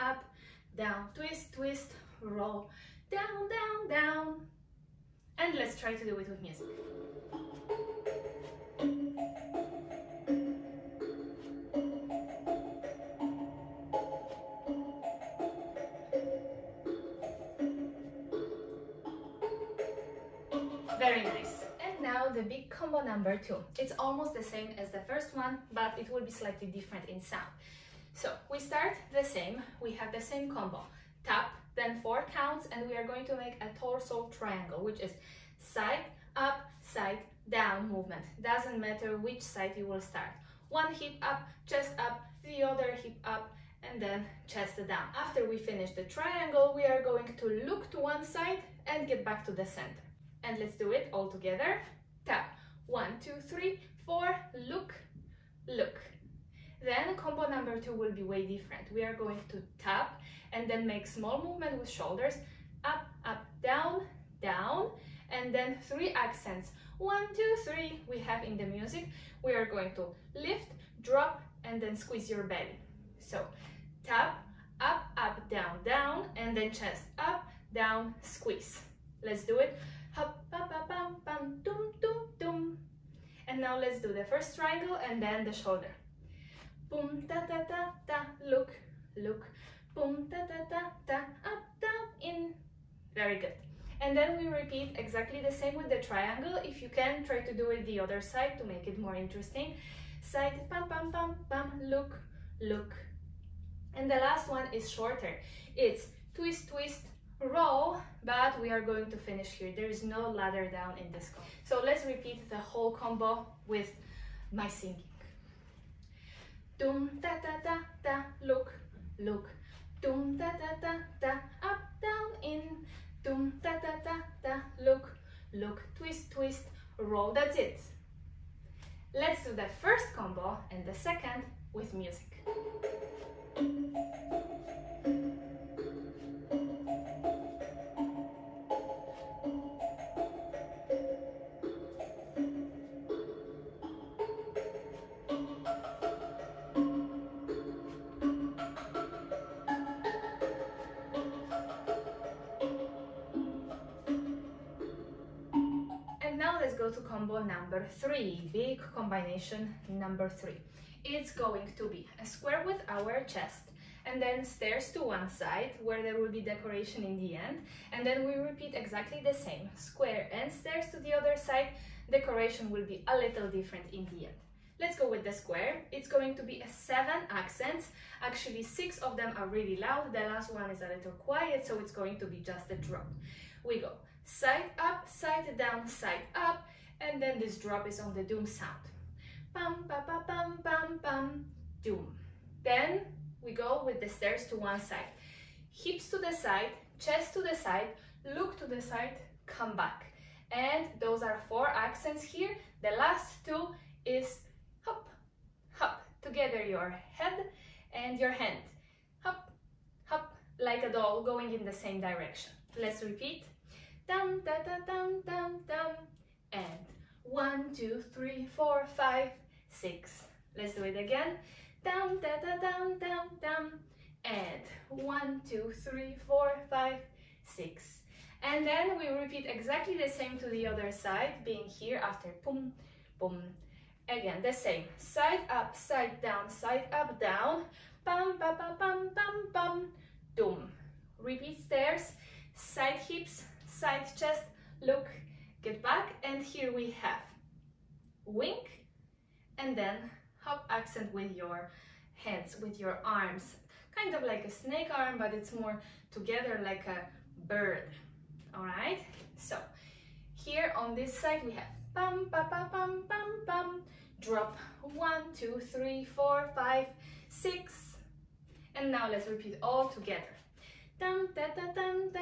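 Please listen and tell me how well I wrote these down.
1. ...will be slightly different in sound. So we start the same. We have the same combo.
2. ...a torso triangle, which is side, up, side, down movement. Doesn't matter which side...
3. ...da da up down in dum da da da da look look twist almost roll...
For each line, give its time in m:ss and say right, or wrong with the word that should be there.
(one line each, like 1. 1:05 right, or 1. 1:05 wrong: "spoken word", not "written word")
1. 0:26 right
2. 0:33 right
3. 2:00 wrong: "twist", not "almost".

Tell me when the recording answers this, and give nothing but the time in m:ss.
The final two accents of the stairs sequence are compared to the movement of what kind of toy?
3:30.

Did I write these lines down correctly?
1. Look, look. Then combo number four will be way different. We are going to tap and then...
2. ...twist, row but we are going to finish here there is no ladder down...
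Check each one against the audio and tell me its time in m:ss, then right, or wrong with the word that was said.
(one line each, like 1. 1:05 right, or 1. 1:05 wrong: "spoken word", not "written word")
1. 0:54 wrong: "two", not "four"
2. 1:46 right.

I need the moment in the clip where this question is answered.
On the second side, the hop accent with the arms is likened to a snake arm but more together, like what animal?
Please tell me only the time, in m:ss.
4:17.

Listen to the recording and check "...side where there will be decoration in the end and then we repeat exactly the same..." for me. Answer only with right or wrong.
right.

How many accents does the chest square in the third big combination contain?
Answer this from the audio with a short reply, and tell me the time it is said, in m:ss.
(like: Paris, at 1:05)
7, at 2:56.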